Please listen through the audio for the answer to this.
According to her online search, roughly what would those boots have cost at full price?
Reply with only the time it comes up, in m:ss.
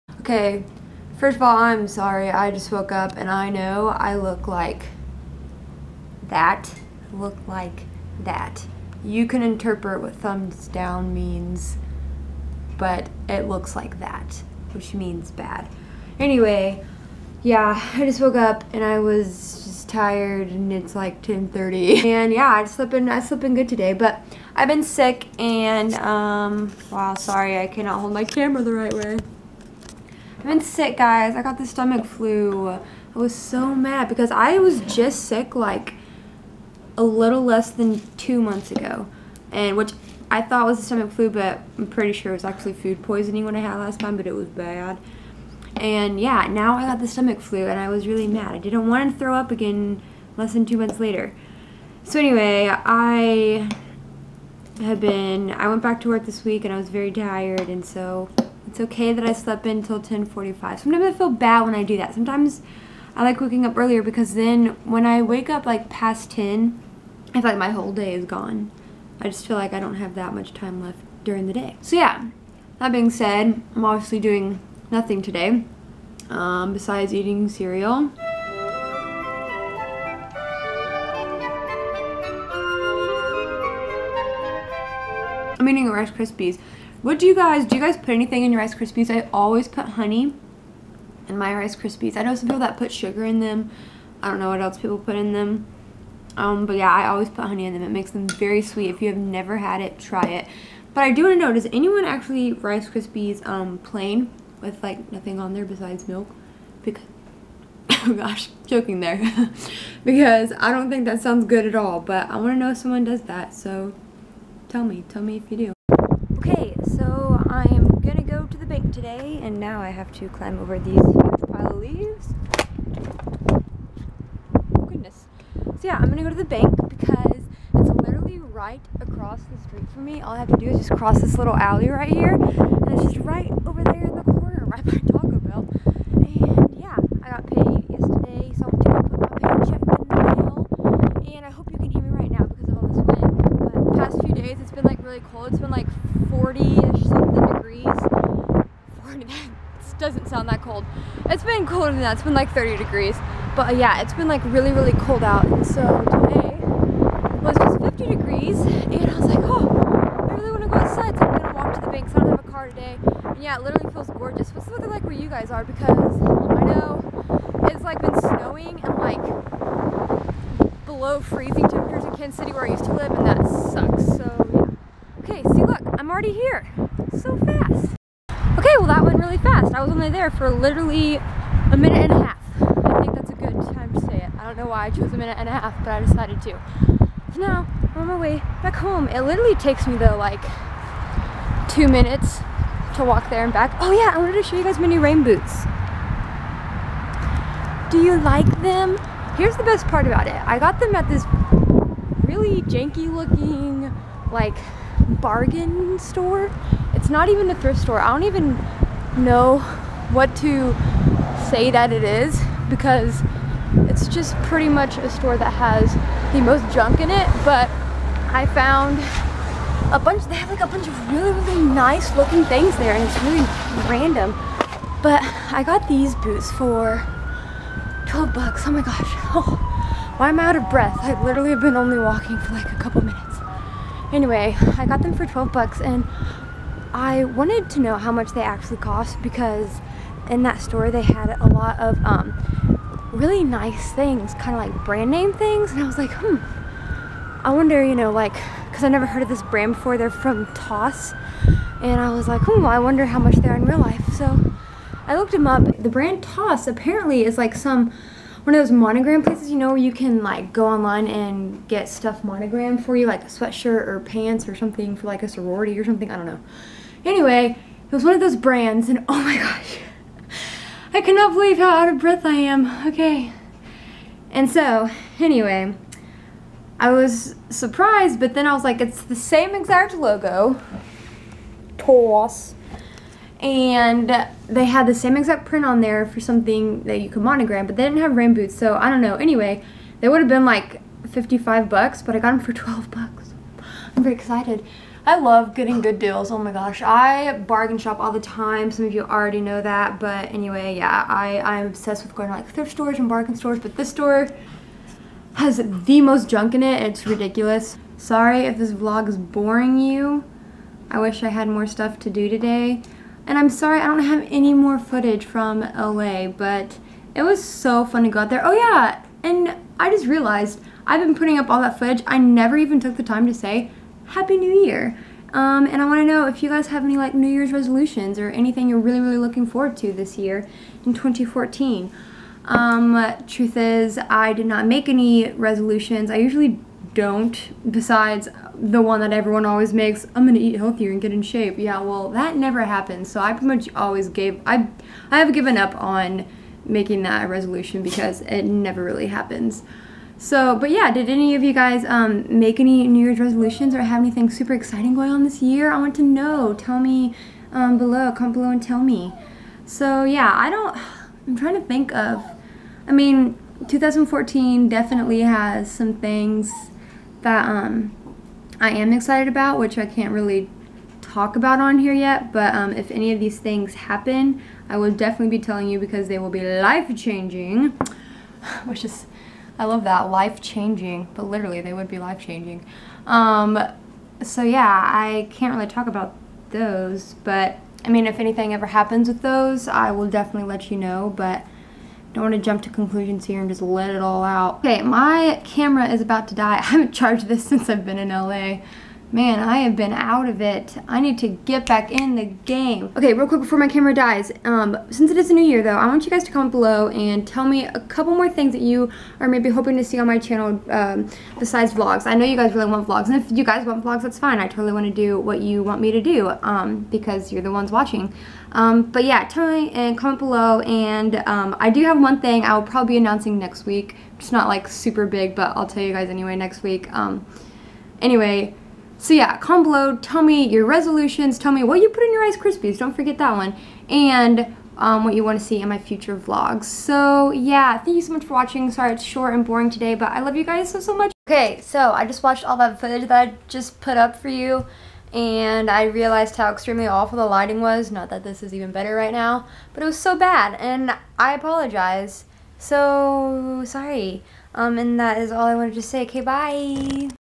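4:51.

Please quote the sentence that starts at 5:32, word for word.
Um, truth is, I did not make any resolutions.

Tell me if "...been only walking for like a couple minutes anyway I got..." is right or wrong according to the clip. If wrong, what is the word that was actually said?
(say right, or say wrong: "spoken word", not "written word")
right.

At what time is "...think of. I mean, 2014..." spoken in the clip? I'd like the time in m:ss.
6:01.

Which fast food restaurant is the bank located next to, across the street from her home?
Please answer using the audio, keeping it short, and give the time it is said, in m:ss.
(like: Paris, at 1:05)
Taco Bell, at 2:14.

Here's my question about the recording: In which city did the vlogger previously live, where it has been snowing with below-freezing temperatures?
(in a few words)
Kansas City.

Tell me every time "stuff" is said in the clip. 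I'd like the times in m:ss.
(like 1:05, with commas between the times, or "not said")
4:21, 5:11.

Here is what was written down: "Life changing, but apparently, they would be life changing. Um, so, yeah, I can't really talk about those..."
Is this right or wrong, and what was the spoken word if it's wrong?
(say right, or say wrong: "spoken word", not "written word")
wrong: "literally", not "apparently".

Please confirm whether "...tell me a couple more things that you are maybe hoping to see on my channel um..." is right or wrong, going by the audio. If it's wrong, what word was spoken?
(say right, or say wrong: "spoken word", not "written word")
right.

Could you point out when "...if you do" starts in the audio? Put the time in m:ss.
1:55.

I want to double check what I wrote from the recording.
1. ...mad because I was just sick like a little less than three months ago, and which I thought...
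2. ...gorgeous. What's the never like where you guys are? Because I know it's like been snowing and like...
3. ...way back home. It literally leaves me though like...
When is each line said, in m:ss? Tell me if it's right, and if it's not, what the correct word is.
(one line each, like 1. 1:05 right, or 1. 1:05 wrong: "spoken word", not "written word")
1. 0:33 wrong: "two", not "three"
2. 2:44 wrong: "weather", not "never"
3. 3:08 wrong: "takes", not "leaves".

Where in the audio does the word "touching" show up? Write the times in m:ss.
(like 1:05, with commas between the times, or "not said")
not said.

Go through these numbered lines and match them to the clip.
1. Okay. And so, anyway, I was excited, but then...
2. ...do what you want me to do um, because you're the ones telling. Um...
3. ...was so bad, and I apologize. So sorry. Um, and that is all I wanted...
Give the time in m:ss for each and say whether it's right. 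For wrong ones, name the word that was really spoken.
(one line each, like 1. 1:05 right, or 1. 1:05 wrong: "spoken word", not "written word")
1. 4:32 wrong: "surprised", not "excited"
2. 6:54 wrong: "watching", not "telling"
3. 7:29 right.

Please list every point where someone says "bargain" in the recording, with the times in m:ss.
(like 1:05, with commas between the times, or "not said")
3:25, 4:57, 5:03.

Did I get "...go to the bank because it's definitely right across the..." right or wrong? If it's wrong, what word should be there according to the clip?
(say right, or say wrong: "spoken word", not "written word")
wrong: "literally", not "definitely".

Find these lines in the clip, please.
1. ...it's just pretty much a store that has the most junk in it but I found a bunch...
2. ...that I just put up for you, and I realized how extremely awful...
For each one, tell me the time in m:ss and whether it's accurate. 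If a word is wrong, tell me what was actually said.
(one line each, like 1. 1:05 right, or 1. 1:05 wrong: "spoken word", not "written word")
1. 3:33 right
2. 7:23 right.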